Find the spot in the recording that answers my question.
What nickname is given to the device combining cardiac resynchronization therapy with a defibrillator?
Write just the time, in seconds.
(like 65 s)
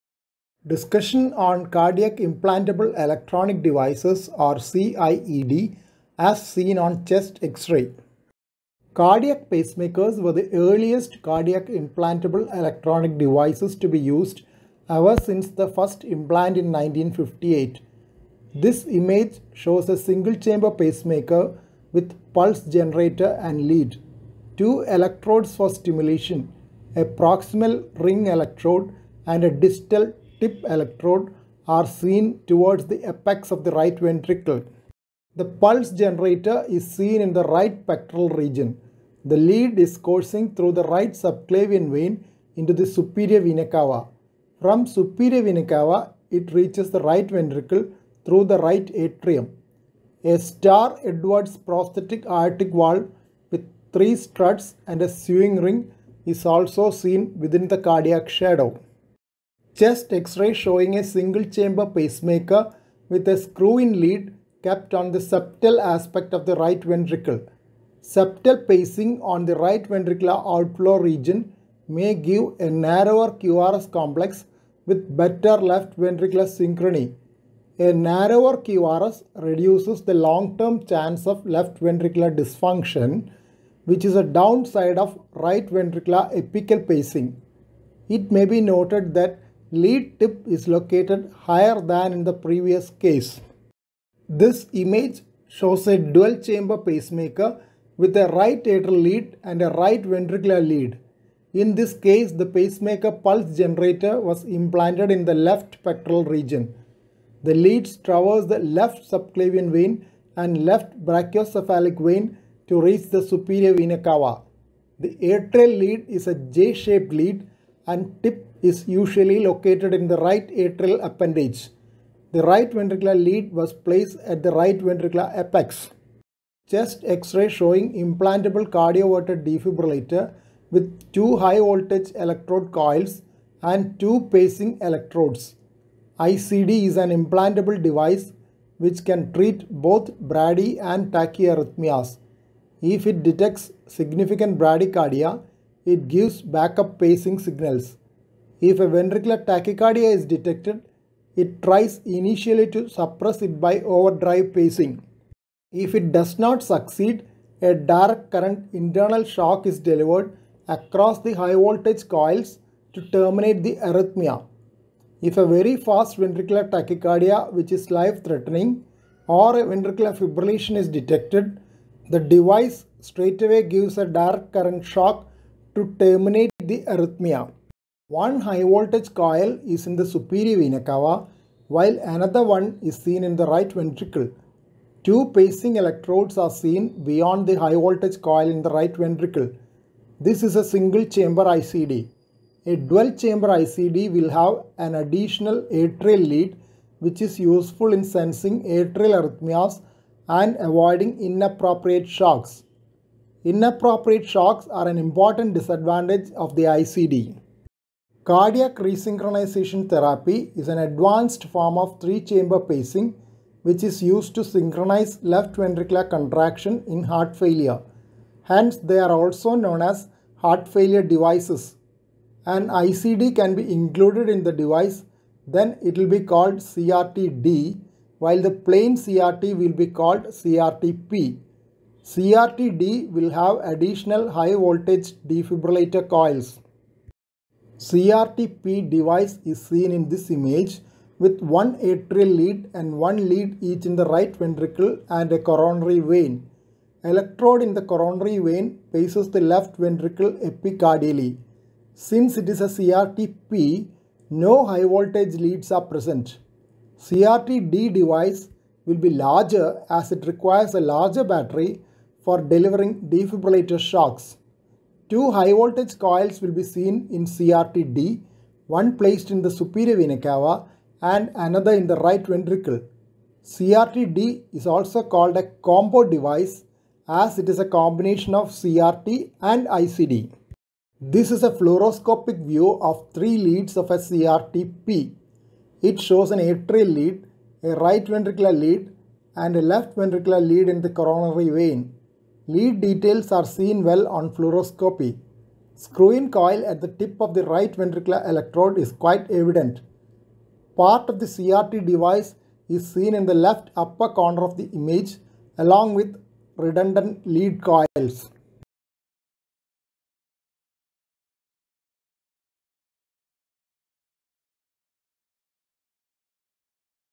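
275 s.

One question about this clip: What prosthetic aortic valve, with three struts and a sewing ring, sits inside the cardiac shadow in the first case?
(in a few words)
Star Edwards.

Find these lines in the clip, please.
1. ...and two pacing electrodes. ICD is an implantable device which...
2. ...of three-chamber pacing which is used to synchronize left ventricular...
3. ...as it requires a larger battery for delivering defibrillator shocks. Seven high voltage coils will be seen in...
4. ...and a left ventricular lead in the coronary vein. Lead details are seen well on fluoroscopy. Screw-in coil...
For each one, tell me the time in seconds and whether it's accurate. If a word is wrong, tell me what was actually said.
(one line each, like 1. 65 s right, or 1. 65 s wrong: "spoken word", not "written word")
1. 133 s right
2. 211 s right
3. 259 s wrong: "Two", not "Seven"
4. 289 s right.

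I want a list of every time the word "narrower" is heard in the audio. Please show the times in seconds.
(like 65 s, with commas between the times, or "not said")
72 s, 77 s.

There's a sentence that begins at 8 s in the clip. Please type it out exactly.
Cardiac pacemakers were the earliest cardiac implantable electronic devices to be used ever since the first implant in 1958.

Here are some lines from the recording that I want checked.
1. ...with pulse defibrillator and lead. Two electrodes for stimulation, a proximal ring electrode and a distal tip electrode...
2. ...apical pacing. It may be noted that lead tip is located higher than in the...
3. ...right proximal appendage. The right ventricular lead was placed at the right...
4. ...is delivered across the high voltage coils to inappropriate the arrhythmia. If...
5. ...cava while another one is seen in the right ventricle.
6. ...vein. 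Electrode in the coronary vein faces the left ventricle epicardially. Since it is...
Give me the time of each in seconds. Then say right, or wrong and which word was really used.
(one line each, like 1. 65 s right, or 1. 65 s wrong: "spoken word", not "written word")
1. 21 s wrong: "generator", not "defibrillator"
2. 86 s right
3. 120 s wrong: "atrial", not "proximal"
4. 159 s wrong: "terminate", not "inappropriate"
5. 180 s right
6. 245 s right.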